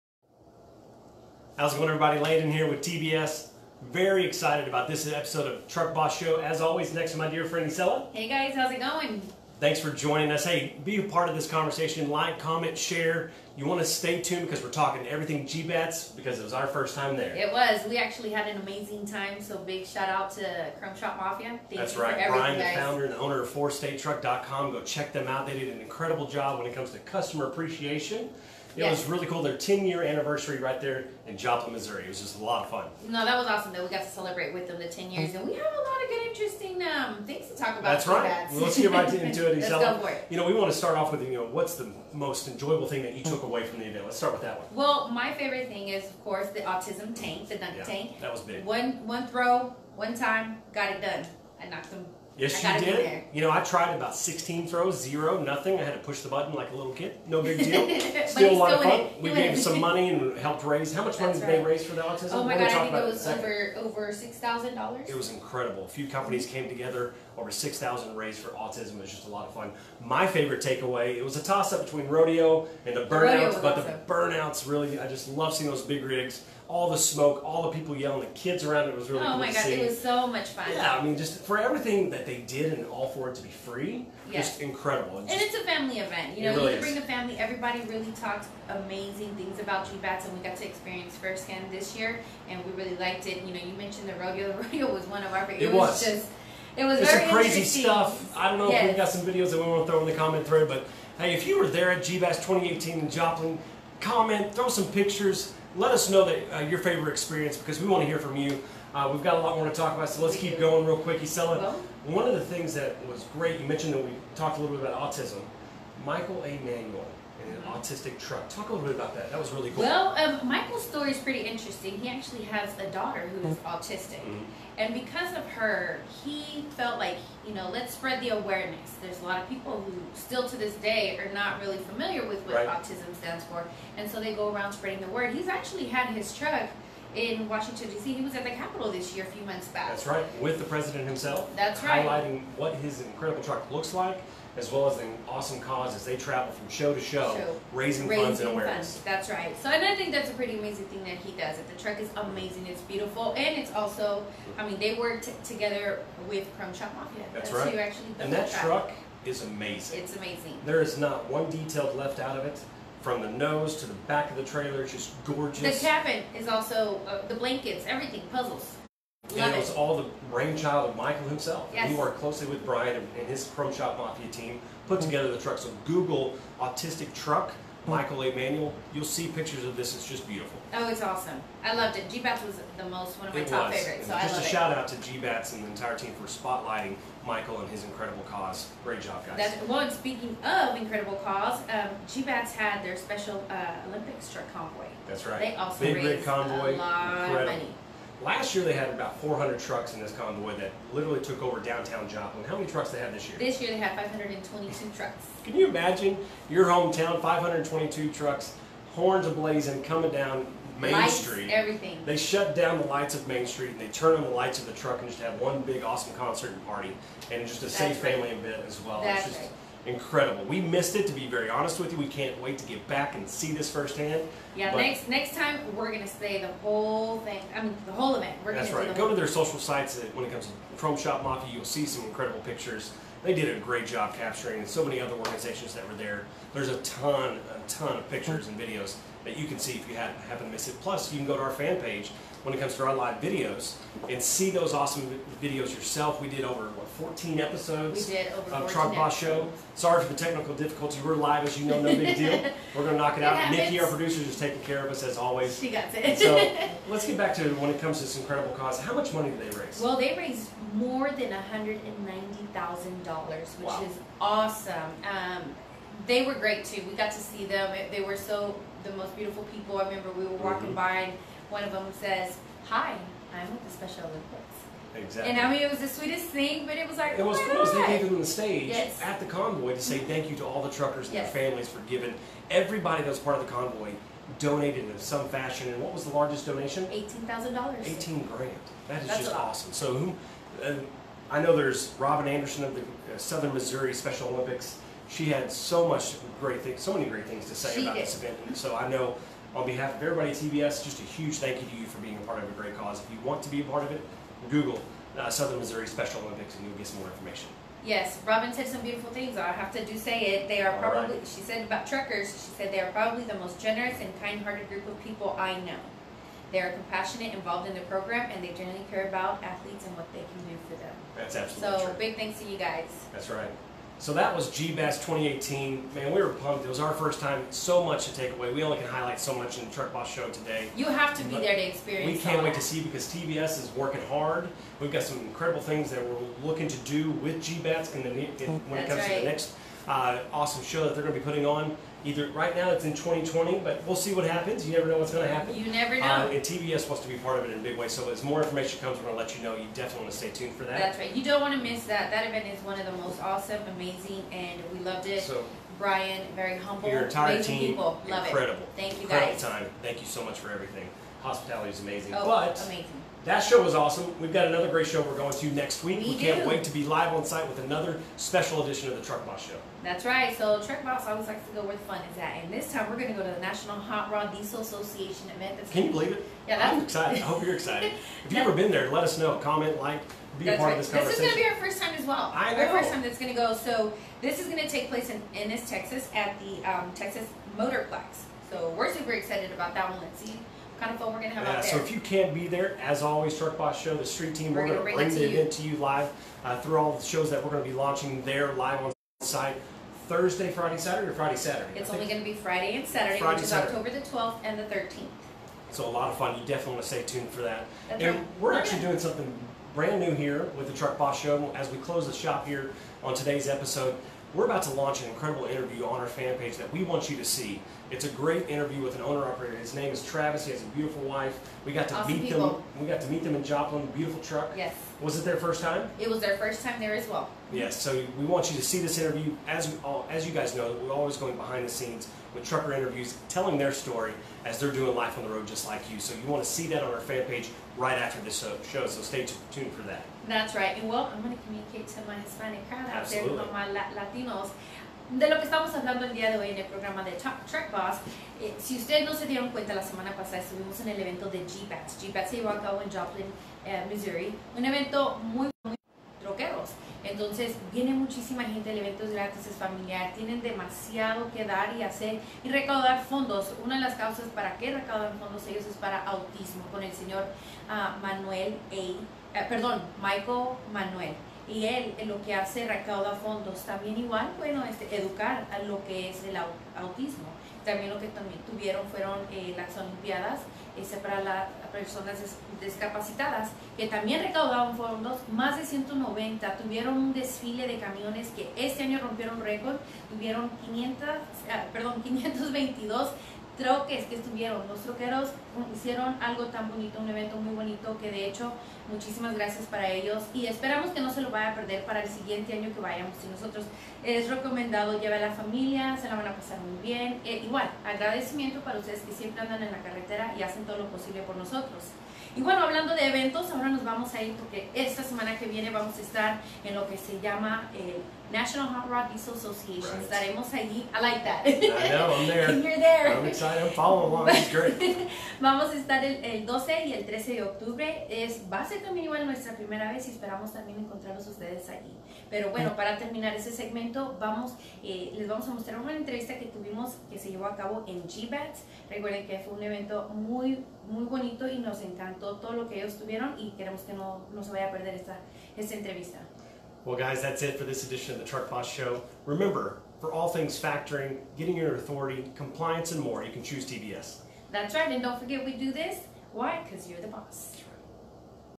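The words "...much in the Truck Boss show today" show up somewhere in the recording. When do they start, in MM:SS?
05:29.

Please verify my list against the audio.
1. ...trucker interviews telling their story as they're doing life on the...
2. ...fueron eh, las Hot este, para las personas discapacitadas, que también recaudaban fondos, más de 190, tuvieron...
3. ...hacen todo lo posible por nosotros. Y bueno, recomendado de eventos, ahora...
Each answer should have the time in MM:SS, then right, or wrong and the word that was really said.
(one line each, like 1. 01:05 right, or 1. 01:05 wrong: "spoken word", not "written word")
1. 07:12 right
2. 07:58 wrong: "Olimpiadas", not "Hot"
3. 08:30 wrong: "hablando", not "recomendado".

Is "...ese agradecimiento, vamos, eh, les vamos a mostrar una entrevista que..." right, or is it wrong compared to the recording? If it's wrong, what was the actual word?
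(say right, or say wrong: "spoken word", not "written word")
wrong: "segmento", not "agradecimiento".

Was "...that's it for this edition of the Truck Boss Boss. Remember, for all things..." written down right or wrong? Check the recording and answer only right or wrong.
wrong.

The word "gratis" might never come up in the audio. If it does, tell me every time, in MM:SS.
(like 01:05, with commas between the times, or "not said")
07:39.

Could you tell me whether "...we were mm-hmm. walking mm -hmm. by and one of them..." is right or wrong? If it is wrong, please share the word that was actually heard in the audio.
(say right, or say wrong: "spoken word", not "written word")
right.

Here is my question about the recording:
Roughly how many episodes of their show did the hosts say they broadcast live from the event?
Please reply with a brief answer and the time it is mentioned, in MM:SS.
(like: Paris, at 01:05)
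14, at 04:06.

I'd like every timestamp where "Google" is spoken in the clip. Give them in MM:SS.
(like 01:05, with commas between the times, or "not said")
02:55, 05:04.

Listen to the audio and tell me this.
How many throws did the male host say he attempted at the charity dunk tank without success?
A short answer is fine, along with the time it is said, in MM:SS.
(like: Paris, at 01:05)
16, at 00:54.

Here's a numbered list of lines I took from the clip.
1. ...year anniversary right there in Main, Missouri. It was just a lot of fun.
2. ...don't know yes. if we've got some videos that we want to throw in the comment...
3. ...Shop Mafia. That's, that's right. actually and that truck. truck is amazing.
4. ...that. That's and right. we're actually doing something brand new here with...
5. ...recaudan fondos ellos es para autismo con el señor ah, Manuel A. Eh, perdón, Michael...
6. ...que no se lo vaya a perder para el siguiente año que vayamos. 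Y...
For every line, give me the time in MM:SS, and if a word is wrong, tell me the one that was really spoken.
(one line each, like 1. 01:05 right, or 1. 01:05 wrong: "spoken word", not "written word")
1. 00:29 wrong: "Joplin", not "Main"
2. 01:38 right
3. 02:36 right
4. 06:47 right
5. 07:44 right
6. 08:20 right.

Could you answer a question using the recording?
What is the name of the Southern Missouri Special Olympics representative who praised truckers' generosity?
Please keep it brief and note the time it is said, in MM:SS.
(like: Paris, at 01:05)
Robin Anderson, at 04:52.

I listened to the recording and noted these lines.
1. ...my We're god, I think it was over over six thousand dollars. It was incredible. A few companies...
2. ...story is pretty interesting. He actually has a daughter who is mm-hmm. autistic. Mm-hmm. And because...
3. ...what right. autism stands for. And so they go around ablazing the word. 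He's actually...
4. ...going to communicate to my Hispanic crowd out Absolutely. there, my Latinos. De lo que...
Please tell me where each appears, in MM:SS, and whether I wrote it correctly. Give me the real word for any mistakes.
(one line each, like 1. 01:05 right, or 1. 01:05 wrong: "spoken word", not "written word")
1. 01:02 right
2. 02:00 right
3. 02:12 wrong: "spreading", not "ablazing"
4. 07:21 right.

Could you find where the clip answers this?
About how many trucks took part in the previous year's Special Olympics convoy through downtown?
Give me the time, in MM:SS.
03:19.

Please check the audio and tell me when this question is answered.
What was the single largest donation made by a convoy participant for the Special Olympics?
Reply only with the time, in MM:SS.
04:46.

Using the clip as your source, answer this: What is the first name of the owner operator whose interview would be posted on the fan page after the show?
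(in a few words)
Travis.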